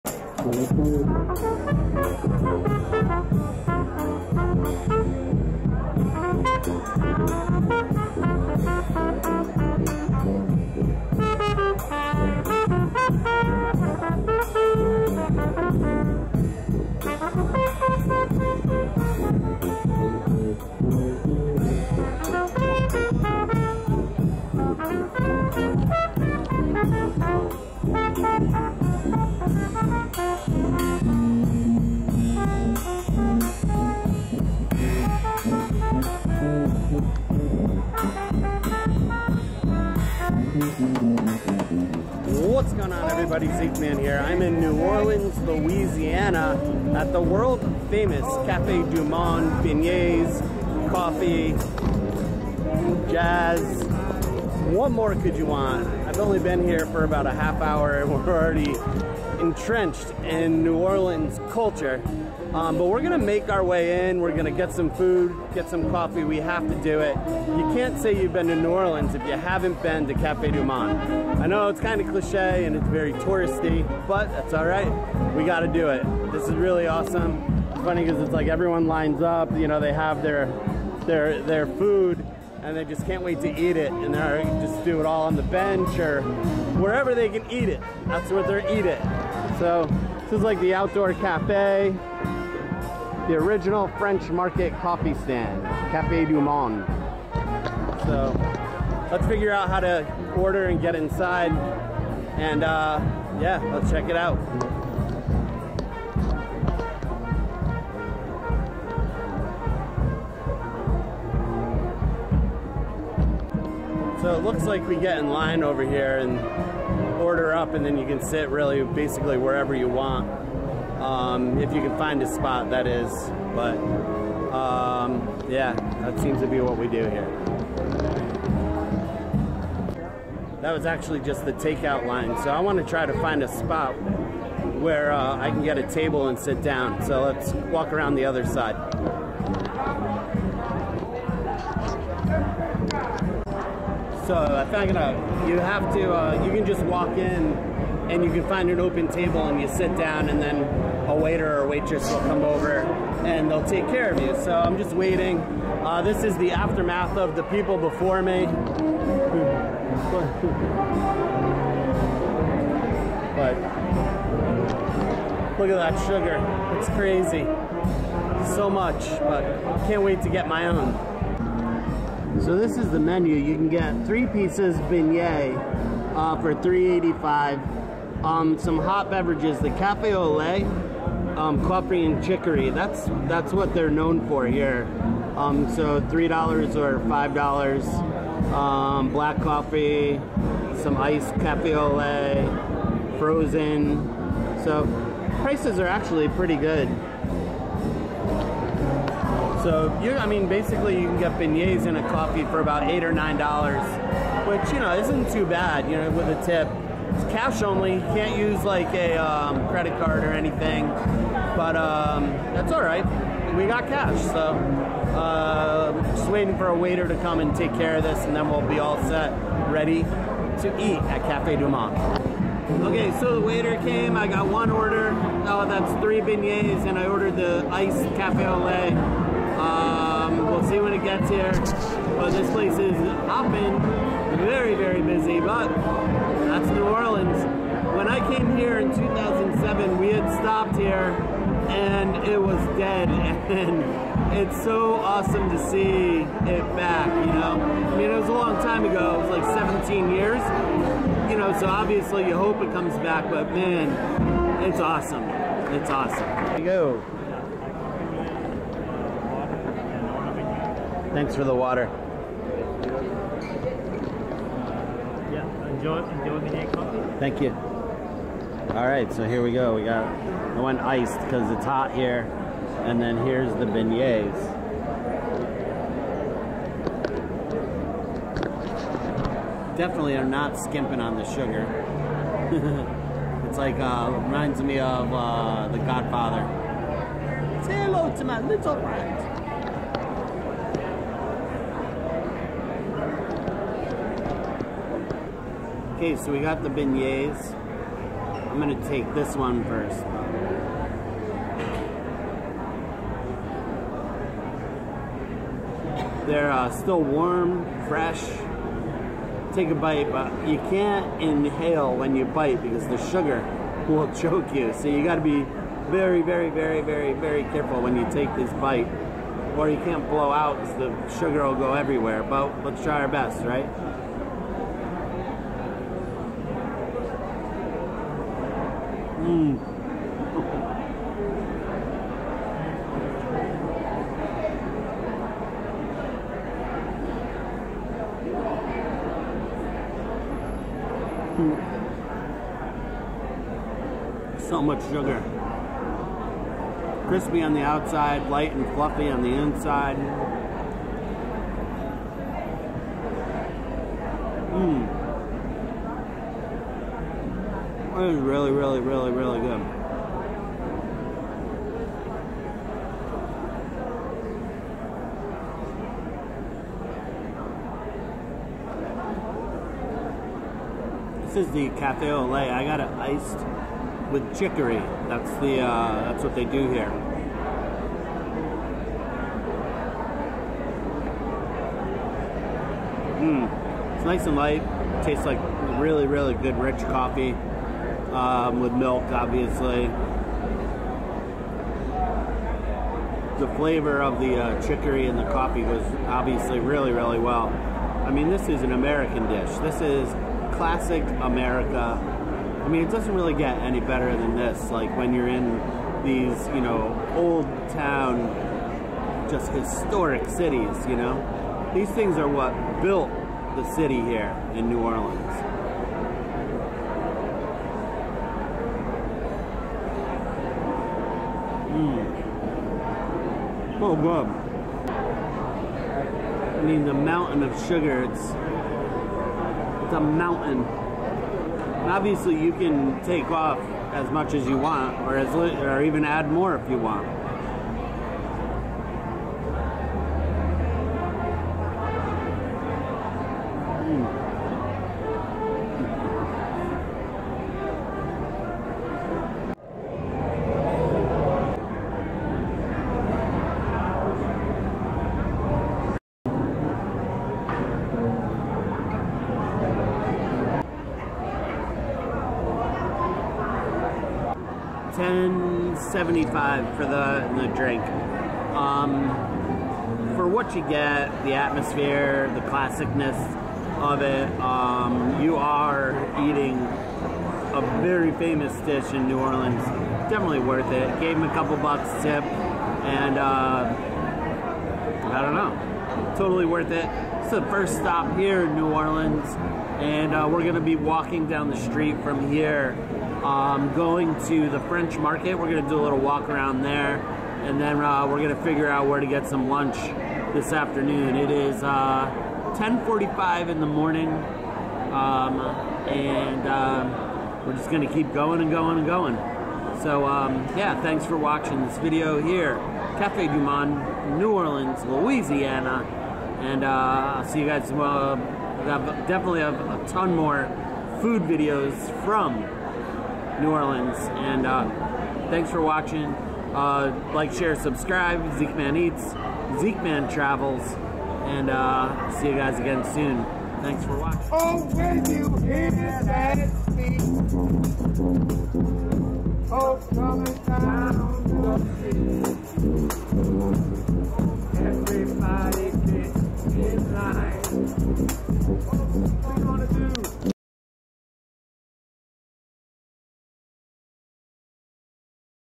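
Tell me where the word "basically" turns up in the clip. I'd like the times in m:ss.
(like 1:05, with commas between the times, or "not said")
1:58, 3:20.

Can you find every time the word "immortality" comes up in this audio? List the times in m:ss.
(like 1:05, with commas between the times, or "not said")
not said.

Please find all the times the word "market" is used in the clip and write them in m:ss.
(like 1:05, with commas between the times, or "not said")
1:34, 8:14.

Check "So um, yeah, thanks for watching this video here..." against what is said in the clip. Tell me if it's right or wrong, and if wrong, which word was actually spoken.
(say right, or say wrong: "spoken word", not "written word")
right.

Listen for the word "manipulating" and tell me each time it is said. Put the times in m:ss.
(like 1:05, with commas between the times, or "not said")
not said.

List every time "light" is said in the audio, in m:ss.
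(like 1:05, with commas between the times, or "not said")
5:48, 6:24.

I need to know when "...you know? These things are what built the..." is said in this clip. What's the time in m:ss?
6:50.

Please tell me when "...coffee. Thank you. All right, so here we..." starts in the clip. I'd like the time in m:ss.
4:26.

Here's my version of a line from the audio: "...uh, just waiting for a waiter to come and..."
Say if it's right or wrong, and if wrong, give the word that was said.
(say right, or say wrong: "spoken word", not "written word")
right.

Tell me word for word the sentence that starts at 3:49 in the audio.
Um, we'll see when it gets here.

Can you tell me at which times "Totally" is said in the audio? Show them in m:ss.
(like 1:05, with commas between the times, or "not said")
8:06.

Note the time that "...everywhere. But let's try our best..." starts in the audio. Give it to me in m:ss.
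5:21.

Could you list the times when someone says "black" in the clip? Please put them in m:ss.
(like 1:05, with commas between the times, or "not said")
3:09.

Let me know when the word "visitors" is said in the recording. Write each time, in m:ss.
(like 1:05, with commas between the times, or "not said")
not said.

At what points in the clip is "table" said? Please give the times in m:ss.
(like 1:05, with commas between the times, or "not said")
2:15, 2:29.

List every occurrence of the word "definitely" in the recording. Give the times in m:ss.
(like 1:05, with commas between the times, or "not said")
4:39, 8:00, 8:39.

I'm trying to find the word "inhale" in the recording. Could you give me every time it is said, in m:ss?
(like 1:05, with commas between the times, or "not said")
5:11.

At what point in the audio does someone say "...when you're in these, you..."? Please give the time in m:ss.
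6:44.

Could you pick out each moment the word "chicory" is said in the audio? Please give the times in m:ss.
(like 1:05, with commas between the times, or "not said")
3:02, 6:14, 6:34.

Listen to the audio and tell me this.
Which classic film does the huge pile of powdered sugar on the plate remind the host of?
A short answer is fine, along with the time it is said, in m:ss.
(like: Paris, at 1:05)
The Godfather, at 4:45.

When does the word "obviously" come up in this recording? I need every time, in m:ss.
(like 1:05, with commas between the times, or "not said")
4:11, 6:29, 6:36, 7:11.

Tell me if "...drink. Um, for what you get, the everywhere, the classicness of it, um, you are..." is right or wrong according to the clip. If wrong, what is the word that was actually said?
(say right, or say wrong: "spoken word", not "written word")
wrong: "atmosphere", not "everywhere".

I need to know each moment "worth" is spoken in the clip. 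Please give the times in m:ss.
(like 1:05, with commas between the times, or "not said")
8:00, 8:06.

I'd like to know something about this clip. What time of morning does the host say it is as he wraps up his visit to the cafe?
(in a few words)
10:45.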